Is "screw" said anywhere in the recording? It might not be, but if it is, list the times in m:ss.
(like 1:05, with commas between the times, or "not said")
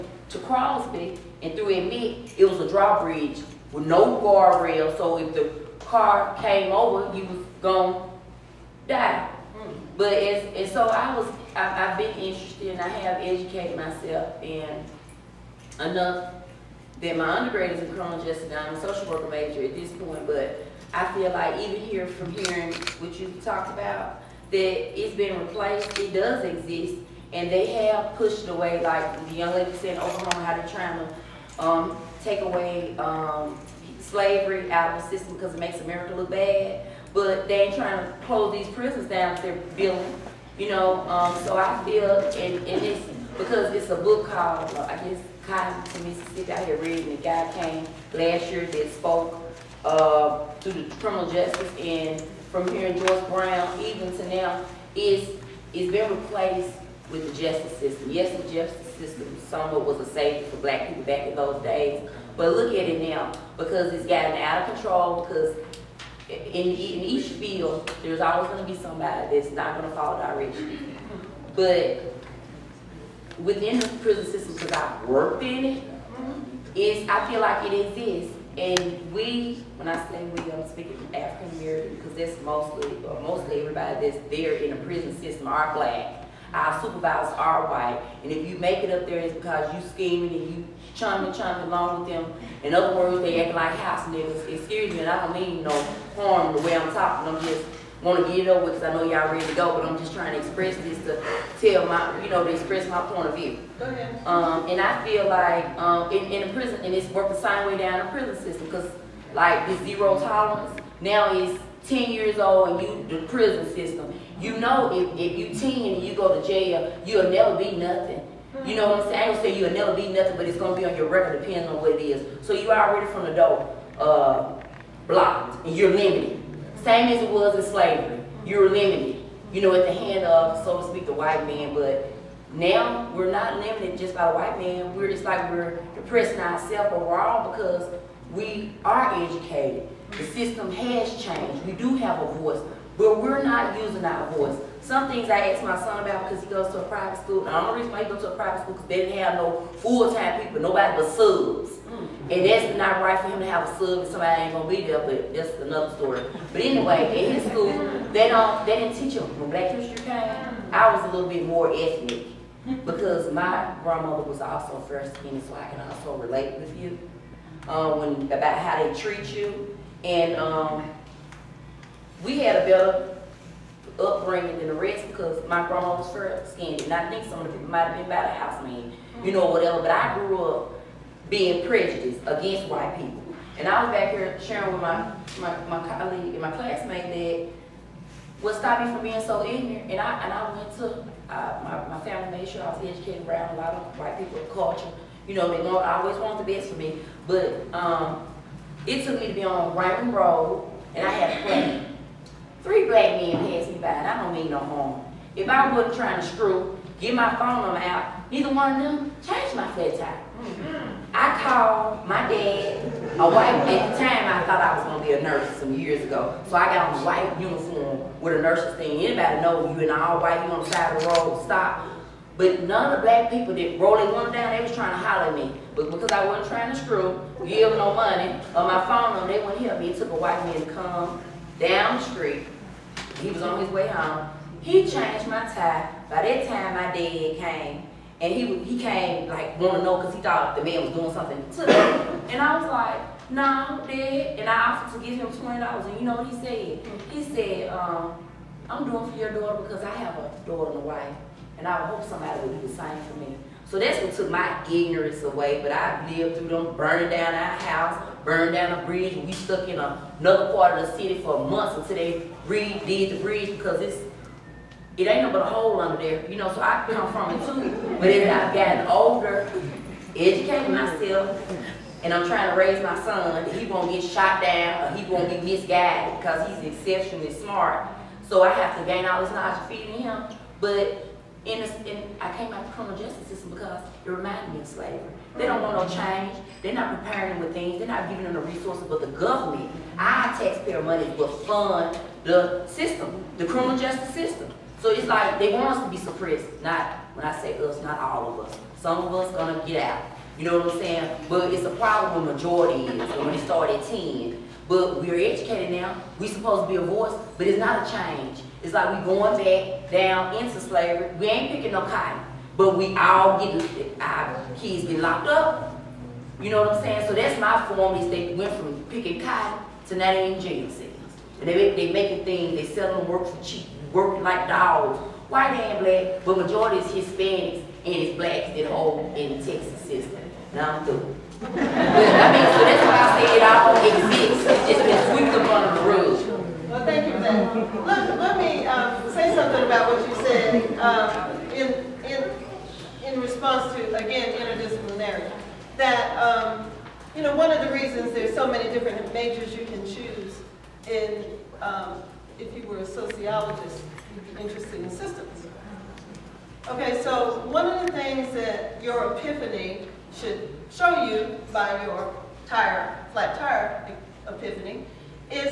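3:26, 3:46.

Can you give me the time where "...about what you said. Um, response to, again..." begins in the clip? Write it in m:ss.
5:39.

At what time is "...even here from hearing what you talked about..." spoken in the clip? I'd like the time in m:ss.
0:21.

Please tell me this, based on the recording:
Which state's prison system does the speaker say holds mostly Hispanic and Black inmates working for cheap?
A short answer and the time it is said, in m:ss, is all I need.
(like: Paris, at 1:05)
Texas, at 5:29.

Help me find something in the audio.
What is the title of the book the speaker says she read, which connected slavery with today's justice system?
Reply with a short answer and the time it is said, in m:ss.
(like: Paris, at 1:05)
Cotton to Mississippi, at 0:45.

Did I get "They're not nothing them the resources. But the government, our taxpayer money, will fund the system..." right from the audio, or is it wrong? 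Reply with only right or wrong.
wrong.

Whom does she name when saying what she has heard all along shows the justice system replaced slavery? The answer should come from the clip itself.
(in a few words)
George Brown.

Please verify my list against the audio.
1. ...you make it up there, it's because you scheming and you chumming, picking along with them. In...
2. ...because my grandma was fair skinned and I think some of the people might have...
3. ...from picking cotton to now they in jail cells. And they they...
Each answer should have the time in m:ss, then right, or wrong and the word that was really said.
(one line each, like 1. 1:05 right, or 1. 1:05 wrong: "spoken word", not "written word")
1. 1:28 wrong: "chumming", not "picking"
2. 2:55 right
3. 5:18 right.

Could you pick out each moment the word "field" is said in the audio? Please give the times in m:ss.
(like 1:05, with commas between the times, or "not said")
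1:07.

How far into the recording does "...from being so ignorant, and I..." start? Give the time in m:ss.
3:08.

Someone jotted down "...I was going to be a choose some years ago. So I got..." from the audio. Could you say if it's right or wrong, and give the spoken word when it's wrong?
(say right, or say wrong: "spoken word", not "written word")
wrong: "nurse", not "choose".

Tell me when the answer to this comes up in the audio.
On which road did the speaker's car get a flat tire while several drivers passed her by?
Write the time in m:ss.
3:19.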